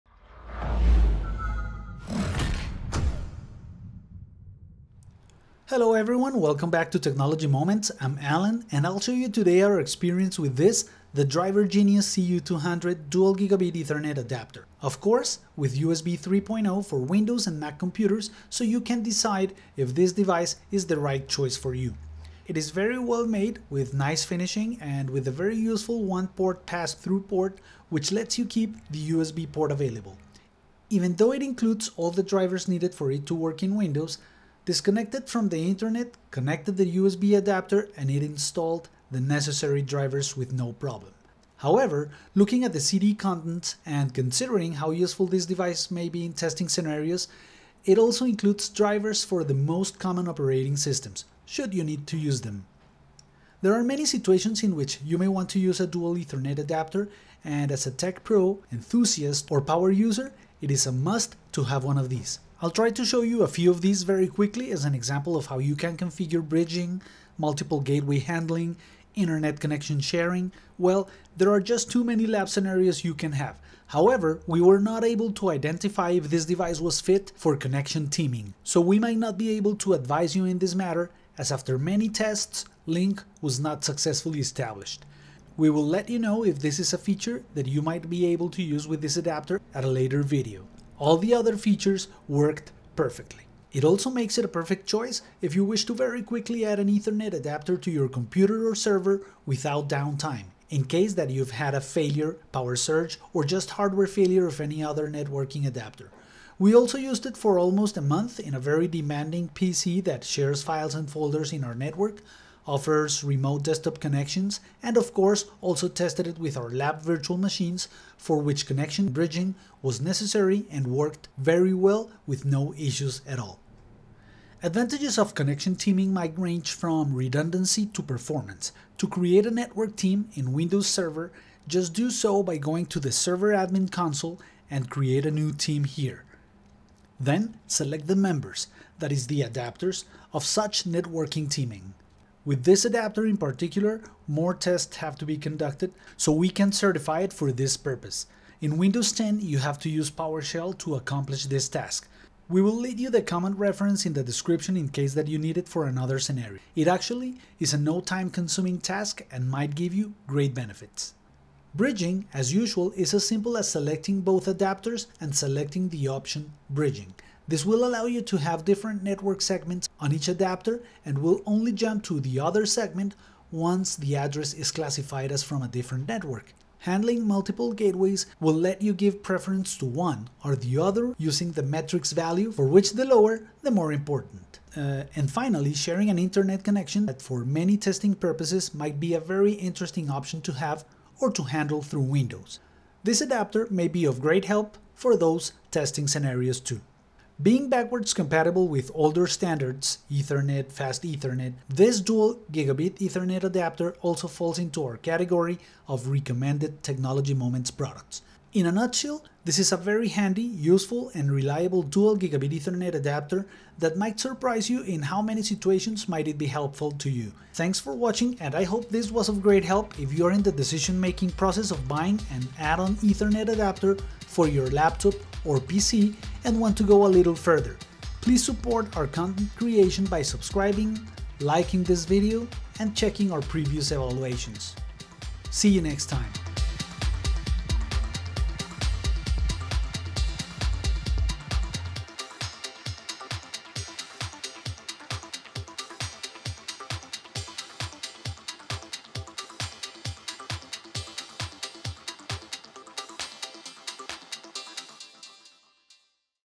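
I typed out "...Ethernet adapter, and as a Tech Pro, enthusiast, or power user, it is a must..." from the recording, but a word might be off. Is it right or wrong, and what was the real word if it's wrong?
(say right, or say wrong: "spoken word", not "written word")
right.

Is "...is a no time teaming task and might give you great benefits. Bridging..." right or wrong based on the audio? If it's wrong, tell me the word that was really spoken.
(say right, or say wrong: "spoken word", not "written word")
wrong: "consuming", not "teaming".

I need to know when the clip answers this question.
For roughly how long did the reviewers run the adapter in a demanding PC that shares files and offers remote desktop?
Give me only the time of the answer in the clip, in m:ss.
1:47.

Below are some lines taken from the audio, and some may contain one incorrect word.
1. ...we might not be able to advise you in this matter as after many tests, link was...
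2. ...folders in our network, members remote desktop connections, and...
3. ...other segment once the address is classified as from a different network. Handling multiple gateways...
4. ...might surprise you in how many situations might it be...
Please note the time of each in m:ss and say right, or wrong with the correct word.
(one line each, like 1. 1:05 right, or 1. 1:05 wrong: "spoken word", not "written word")
1. 1:18 right
2. 1:51 wrong: "offers", not "members"
3. 2:52 right
4. 3:33 right.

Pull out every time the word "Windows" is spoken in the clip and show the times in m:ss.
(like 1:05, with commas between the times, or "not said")
0:16, 0:33, 2:10, 2:28, 3:12.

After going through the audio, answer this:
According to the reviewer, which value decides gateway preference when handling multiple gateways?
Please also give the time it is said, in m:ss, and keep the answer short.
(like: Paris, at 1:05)
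matrix value, at 3:01.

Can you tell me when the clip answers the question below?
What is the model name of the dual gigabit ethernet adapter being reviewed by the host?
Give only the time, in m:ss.
0:11.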